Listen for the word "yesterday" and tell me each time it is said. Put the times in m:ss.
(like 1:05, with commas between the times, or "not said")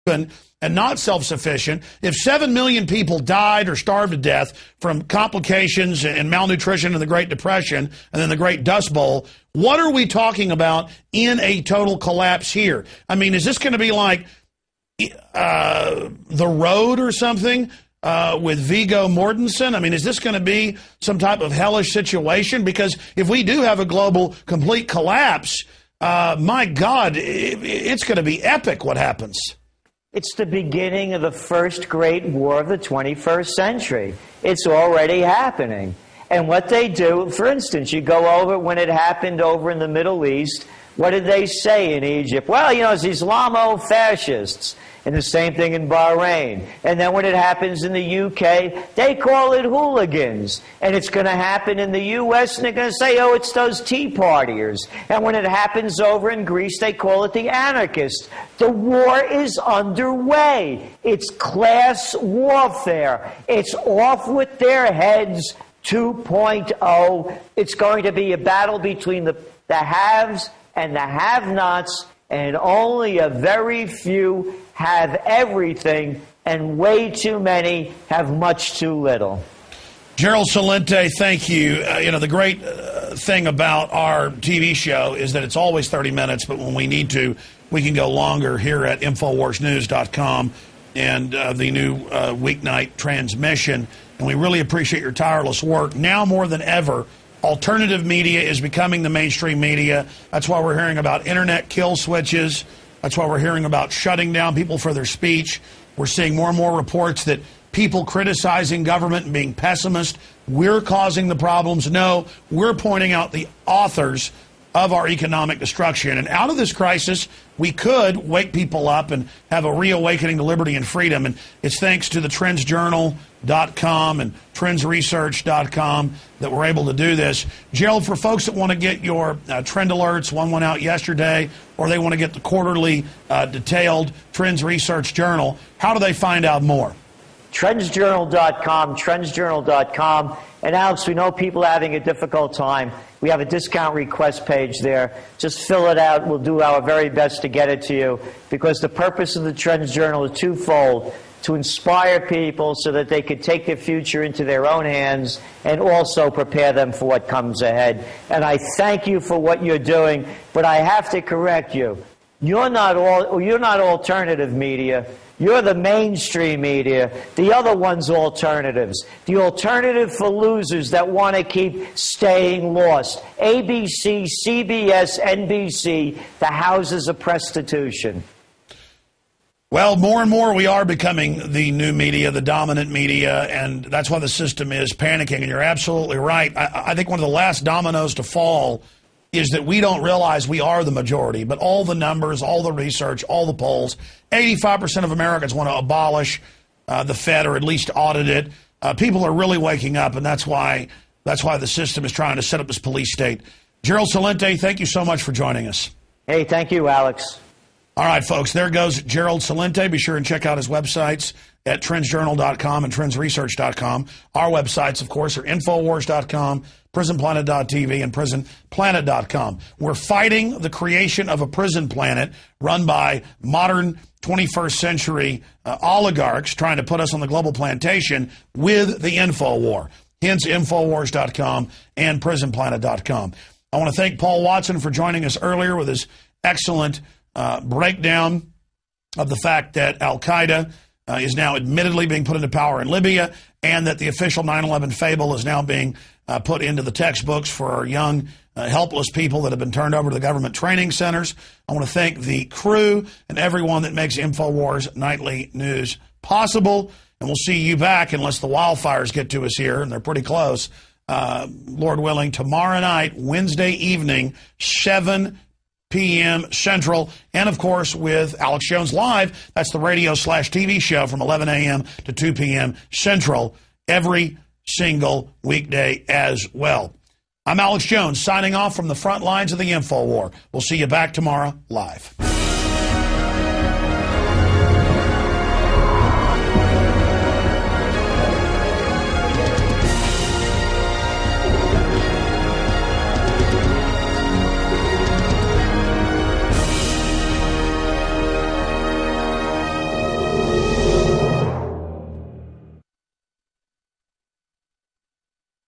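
2:10.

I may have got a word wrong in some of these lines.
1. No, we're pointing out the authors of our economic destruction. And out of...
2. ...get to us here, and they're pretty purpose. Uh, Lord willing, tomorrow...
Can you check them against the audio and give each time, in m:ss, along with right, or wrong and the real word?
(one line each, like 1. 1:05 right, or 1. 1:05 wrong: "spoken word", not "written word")
1. 1:51 right
2. 4:19 wrong: "close", not "purpose".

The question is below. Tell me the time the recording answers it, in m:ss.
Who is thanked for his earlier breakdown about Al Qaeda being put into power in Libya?
3:54.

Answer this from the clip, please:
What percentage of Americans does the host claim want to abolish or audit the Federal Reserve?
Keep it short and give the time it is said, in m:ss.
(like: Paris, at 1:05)
85%, at 3:14.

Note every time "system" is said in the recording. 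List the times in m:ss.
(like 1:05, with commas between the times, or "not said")
3:04, 3:21.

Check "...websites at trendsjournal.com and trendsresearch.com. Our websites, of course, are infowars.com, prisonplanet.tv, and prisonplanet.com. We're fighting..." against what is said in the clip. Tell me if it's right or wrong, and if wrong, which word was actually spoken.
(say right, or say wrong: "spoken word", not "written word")
right.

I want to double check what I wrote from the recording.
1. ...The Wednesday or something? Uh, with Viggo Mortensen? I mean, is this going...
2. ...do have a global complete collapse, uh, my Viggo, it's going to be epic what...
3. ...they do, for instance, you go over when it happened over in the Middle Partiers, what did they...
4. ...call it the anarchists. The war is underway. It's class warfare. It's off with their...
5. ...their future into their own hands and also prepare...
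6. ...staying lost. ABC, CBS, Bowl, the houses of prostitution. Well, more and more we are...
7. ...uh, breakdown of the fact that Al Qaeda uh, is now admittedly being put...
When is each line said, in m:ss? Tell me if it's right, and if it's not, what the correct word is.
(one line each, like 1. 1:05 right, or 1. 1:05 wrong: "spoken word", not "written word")
1. 0:16 wrong: "Road", not "Wednesday"
2. 0:23 wrong: "God", not "Viggo"
3. 0:36 wrong: "East", not "Partiers"
4. 0:56 right
5. 2:33 right
6. 2:51 wrong: "NBC", not "Bowl"
7. 3:57 right.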